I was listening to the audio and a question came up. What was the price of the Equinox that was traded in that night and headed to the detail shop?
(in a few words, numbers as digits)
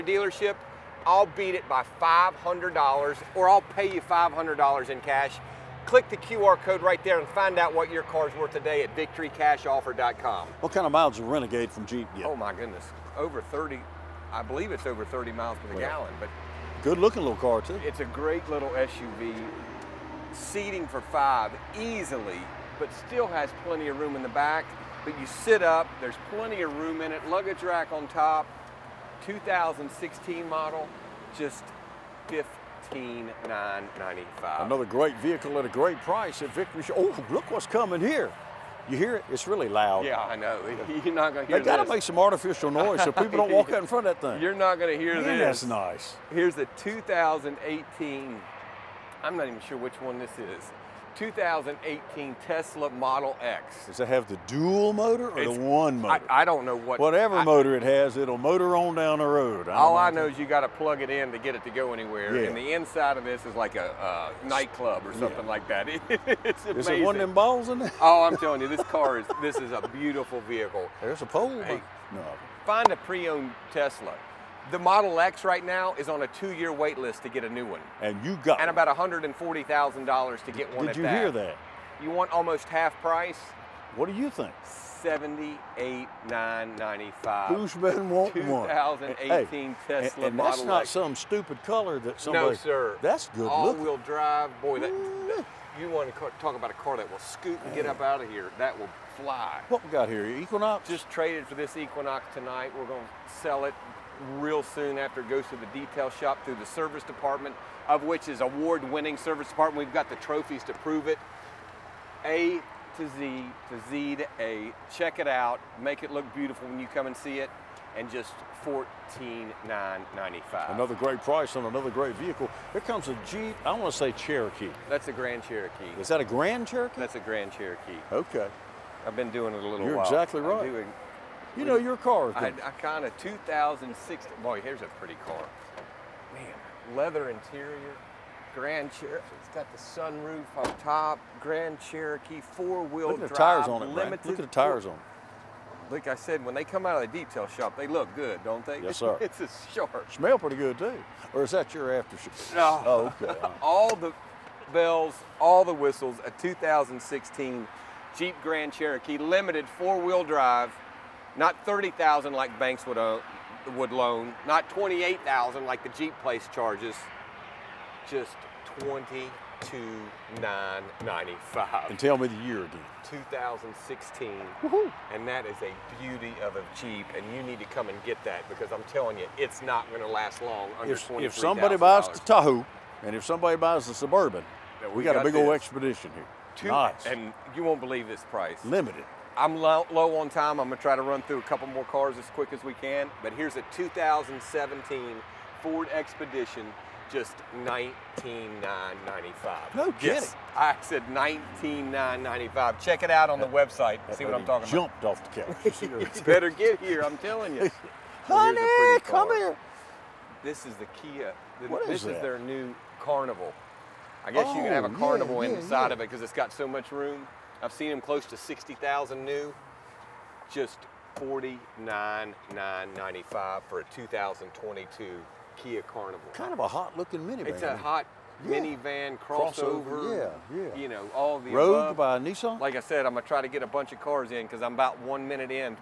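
$14,995.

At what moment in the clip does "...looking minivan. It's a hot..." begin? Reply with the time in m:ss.
3:46.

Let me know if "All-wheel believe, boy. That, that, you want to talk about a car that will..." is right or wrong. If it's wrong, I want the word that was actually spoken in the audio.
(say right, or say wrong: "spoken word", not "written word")
wrong: "drive", not "believe".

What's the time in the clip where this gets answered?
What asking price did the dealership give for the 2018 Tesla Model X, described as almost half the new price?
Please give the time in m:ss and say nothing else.
1:24.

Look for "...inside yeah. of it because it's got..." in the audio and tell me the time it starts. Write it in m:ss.
3:35.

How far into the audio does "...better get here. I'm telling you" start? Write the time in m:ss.
3:26.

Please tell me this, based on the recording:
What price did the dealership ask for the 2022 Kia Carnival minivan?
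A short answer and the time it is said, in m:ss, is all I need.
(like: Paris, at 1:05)
$49,995, at 3:41.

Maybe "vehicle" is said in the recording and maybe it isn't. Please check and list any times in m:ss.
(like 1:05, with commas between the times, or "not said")
0:35, 1:10, 2:02.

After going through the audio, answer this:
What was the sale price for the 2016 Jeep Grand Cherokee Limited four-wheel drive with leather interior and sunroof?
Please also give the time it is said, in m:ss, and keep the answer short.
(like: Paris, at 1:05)
$22,995, at 2:48.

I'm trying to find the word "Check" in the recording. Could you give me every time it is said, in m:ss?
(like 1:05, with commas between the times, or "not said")
1:54, 3:22.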